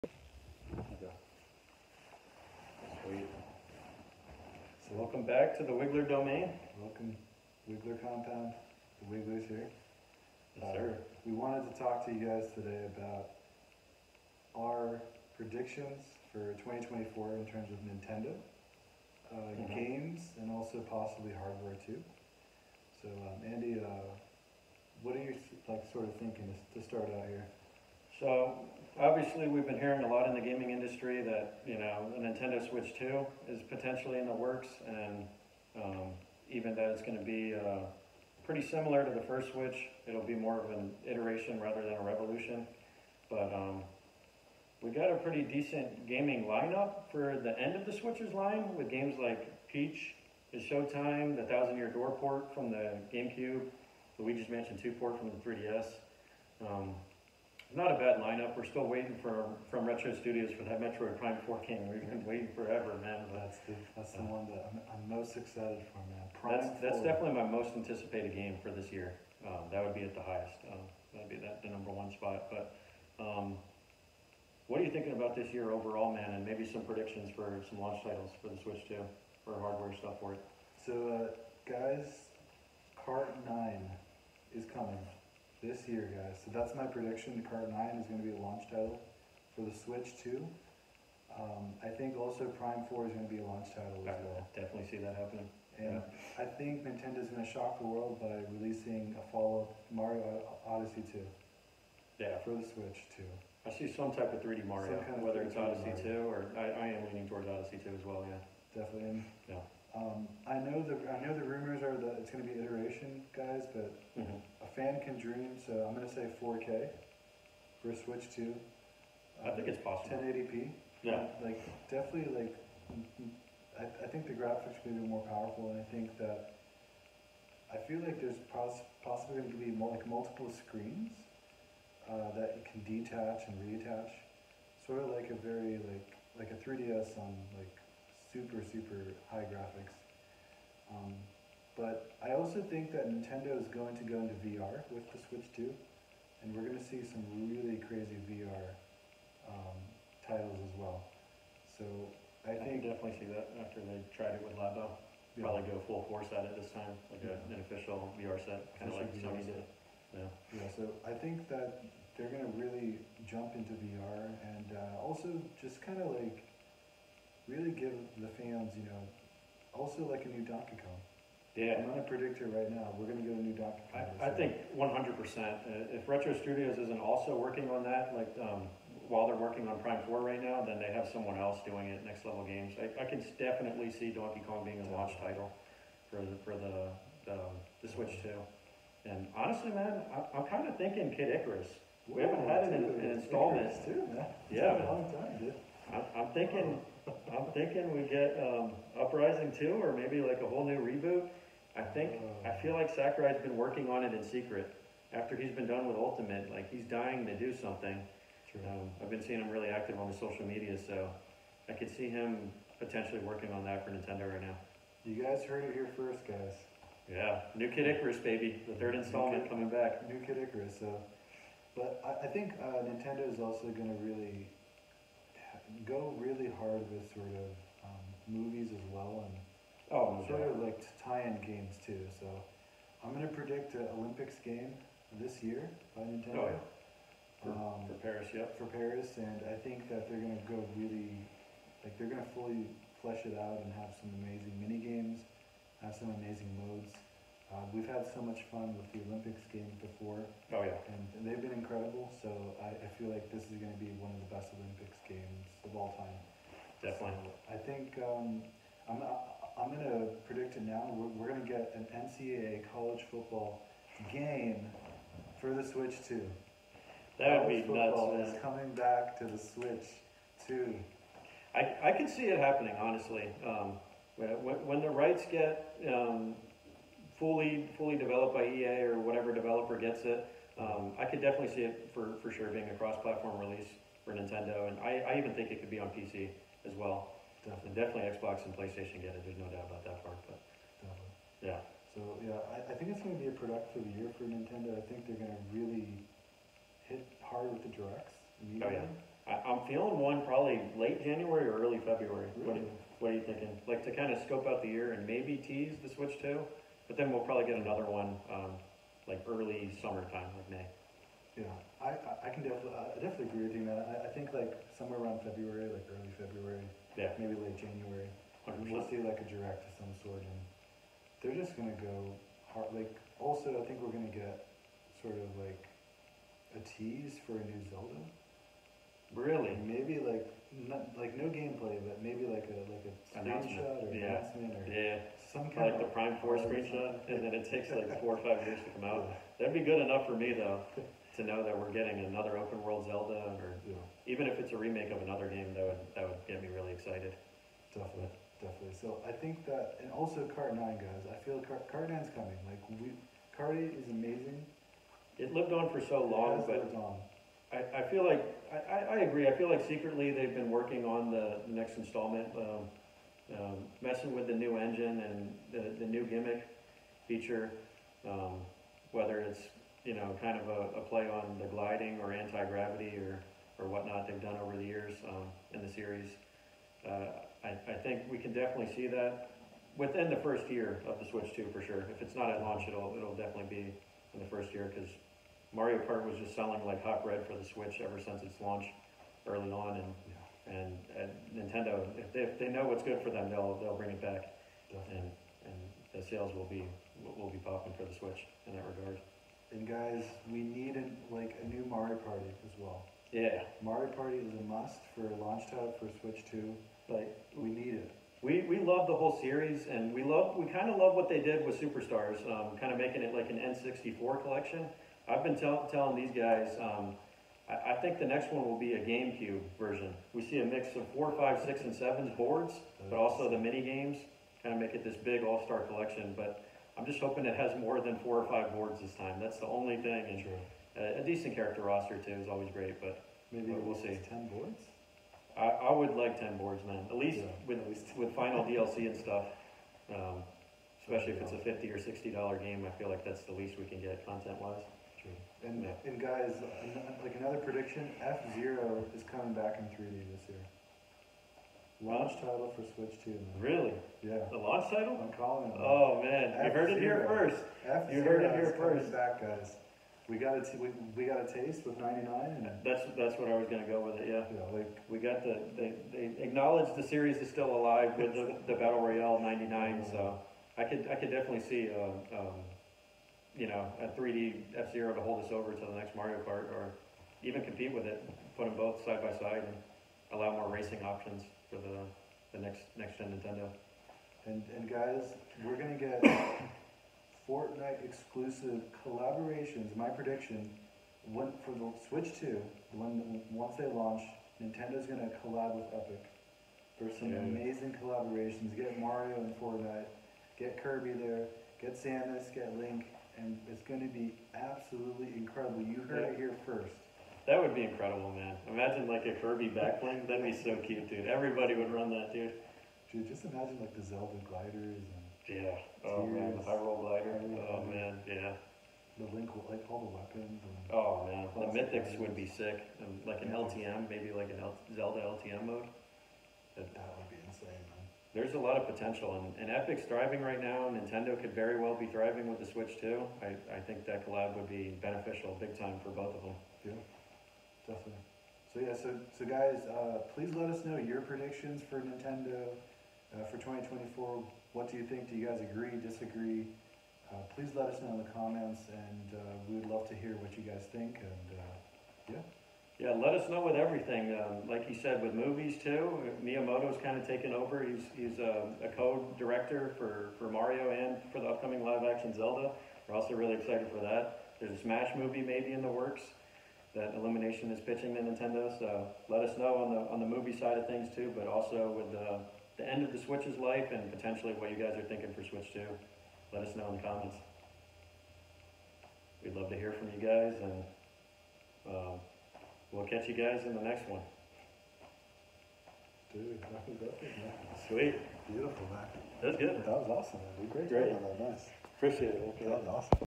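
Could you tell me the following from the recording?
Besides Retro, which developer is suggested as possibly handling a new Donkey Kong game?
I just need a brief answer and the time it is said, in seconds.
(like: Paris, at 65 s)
Next Level Games, at 182 s.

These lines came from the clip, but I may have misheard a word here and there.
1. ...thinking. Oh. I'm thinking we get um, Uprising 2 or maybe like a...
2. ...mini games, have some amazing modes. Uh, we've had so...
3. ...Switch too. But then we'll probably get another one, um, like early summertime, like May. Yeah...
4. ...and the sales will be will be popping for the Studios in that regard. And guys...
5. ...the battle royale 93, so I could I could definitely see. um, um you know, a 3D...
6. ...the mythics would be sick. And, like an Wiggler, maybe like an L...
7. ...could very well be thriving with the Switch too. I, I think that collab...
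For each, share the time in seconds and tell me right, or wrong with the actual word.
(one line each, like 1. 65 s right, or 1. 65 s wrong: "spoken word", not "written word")
1. 196 s right
2. 244 s right
3. 305 s right
4. 395 s wrong: "Switch", not "Studios"
5. 468 s wrong: "99", not "93"
6. 521 s wrong: "LTM", not "Wiggler"
7. 531 s right.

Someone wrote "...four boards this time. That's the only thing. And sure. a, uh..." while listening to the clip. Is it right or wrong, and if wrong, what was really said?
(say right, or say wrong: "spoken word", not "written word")
wrong: "five", not "four".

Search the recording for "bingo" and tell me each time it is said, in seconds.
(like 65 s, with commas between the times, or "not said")
not said.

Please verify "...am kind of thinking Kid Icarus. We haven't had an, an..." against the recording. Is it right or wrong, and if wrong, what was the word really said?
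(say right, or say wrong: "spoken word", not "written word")
right.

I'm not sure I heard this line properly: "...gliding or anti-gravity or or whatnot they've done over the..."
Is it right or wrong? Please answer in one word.
right.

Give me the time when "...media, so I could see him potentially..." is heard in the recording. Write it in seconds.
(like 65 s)
210 s.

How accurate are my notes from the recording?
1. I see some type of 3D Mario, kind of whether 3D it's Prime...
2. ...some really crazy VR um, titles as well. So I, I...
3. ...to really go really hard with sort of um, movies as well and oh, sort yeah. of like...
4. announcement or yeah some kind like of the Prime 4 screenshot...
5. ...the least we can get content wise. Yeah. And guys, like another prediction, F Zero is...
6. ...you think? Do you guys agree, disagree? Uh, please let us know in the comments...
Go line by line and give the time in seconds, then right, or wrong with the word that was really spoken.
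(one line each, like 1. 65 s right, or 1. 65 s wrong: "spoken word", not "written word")
1. 103 s wrong: "Odyssey", not "Prime"
2. 147 s right
3. 223 s right
4. 334 s right
5. 443 s right
6. 544 s right.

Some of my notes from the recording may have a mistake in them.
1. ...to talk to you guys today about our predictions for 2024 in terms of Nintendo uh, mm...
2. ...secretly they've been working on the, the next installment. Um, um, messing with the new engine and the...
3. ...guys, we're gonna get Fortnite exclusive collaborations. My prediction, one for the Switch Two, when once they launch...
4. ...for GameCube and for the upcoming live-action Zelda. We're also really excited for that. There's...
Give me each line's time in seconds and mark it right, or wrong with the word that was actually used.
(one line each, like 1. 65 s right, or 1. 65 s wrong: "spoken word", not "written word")
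1. 11 s right
2. 359 s right
3. 484 s right
4. 560 s wrong: "Mario", not "GameCube".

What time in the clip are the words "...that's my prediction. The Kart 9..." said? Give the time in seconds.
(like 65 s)
86 s.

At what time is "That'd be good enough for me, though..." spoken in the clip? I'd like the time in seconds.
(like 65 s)
339 s.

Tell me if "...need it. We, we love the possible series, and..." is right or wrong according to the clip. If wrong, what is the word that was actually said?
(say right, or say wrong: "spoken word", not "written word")
wrong: "whole", not "possible".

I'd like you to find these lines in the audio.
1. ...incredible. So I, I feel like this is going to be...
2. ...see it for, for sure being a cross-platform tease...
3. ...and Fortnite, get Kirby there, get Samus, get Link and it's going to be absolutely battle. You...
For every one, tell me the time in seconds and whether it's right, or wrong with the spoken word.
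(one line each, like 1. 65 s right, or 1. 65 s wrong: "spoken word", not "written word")
1. 251 s right
2. 281 s wrong: "release", not "tease"
3. 499 s wrong: "incredible", not "battle".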